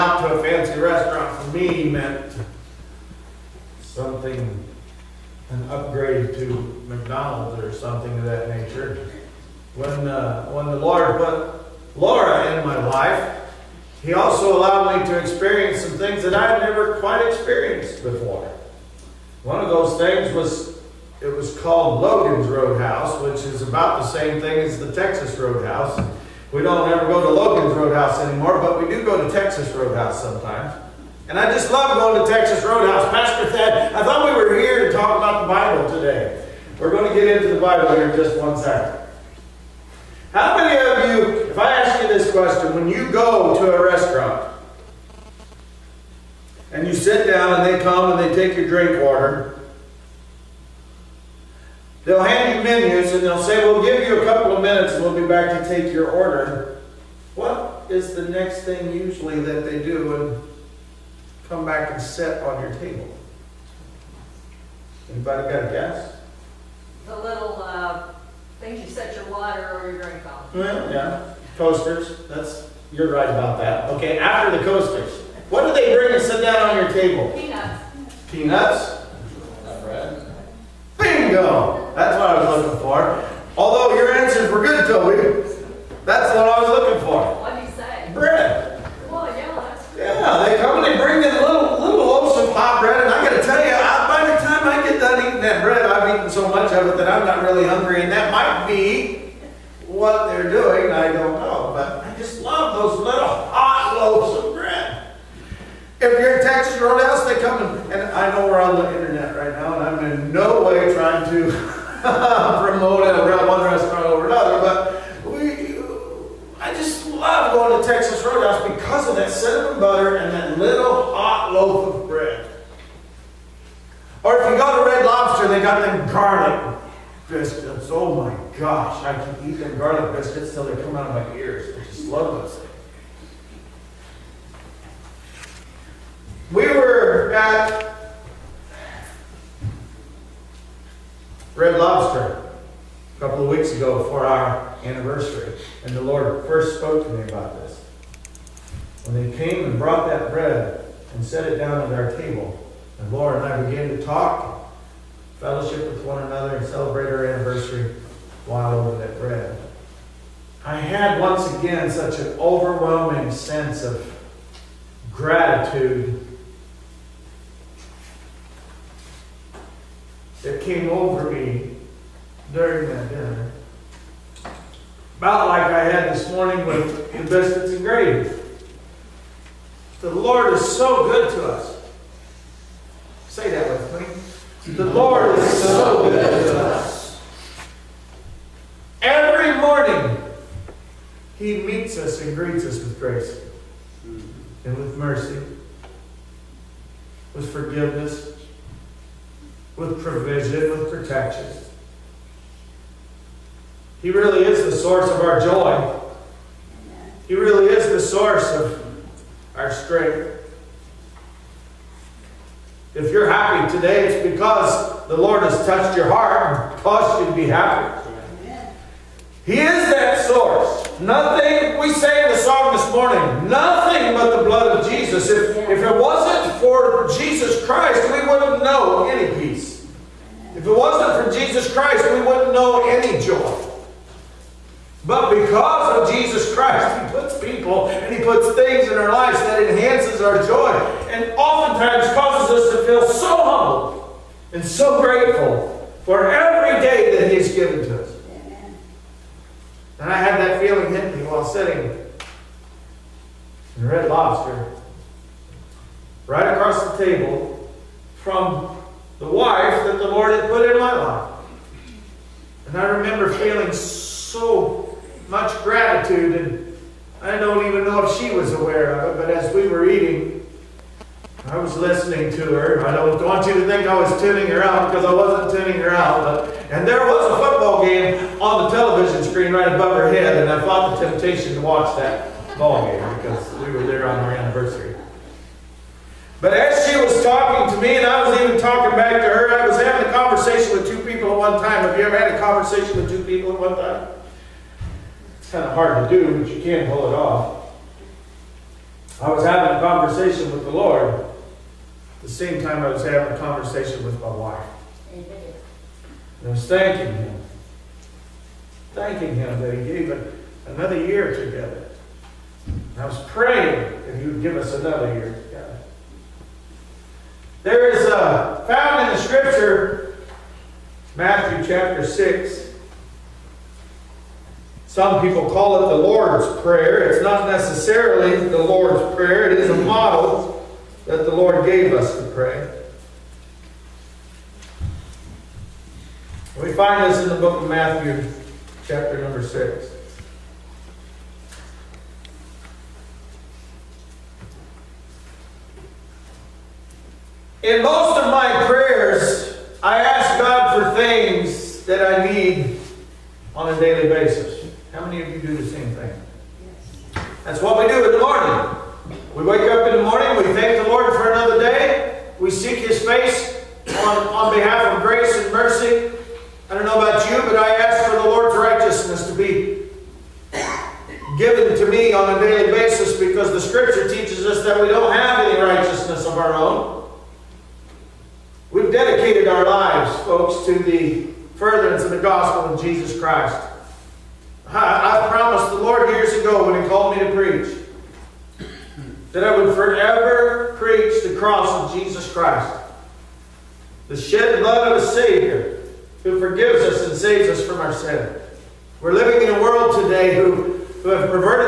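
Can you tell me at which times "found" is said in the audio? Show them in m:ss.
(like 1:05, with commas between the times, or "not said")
5:18.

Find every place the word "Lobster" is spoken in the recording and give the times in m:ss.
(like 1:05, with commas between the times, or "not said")
2:05, 4:14.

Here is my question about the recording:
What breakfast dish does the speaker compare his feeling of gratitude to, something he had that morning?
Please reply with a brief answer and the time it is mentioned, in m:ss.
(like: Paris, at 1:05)
Biscuits and gravy, at 2:57.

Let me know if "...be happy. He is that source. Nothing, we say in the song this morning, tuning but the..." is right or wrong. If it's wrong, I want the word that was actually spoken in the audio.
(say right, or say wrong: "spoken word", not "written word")
wrong: "nothing", not "tuning".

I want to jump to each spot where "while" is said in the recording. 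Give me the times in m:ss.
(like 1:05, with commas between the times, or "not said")
2:38, 4:11.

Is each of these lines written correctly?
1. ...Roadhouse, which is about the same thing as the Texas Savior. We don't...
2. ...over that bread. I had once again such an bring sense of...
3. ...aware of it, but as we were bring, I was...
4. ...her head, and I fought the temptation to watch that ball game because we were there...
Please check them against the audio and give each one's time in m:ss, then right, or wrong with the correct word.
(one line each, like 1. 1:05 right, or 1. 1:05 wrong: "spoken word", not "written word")
1. 0:22 wrong: "Roadhouse", not "Savior"
2. 2:38 wrong: "overwhelming", not "bring"
3. 4:28 wrong: "eating", not "bring"
4. 4:39 right.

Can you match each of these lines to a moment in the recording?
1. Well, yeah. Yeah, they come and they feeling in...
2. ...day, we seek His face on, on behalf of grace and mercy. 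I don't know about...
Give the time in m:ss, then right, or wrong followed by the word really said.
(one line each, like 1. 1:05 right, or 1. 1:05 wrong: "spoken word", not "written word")
1. 1:29 wrong: "bring", not "feeling"
2. 6:01 right.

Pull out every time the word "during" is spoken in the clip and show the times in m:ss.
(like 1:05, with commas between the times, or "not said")
2:52.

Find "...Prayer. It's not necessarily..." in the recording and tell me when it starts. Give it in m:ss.
5:26.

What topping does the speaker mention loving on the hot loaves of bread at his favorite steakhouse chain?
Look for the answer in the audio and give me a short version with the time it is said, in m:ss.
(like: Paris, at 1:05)
Cinnamon butter, at 1:59.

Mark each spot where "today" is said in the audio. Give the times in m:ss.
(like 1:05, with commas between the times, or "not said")
0:35, 3:33, 6:40.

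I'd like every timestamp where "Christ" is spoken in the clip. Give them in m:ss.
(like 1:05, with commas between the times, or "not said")
3:47, 3:51, 3:56, 6:23, 6:32.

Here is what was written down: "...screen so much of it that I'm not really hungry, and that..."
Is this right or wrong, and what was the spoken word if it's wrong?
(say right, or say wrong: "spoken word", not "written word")
wrong: "eaten", not "screen".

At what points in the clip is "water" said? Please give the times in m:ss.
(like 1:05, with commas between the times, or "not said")
0:49, 1:09.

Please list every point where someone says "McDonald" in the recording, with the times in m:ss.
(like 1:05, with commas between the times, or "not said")
0:06.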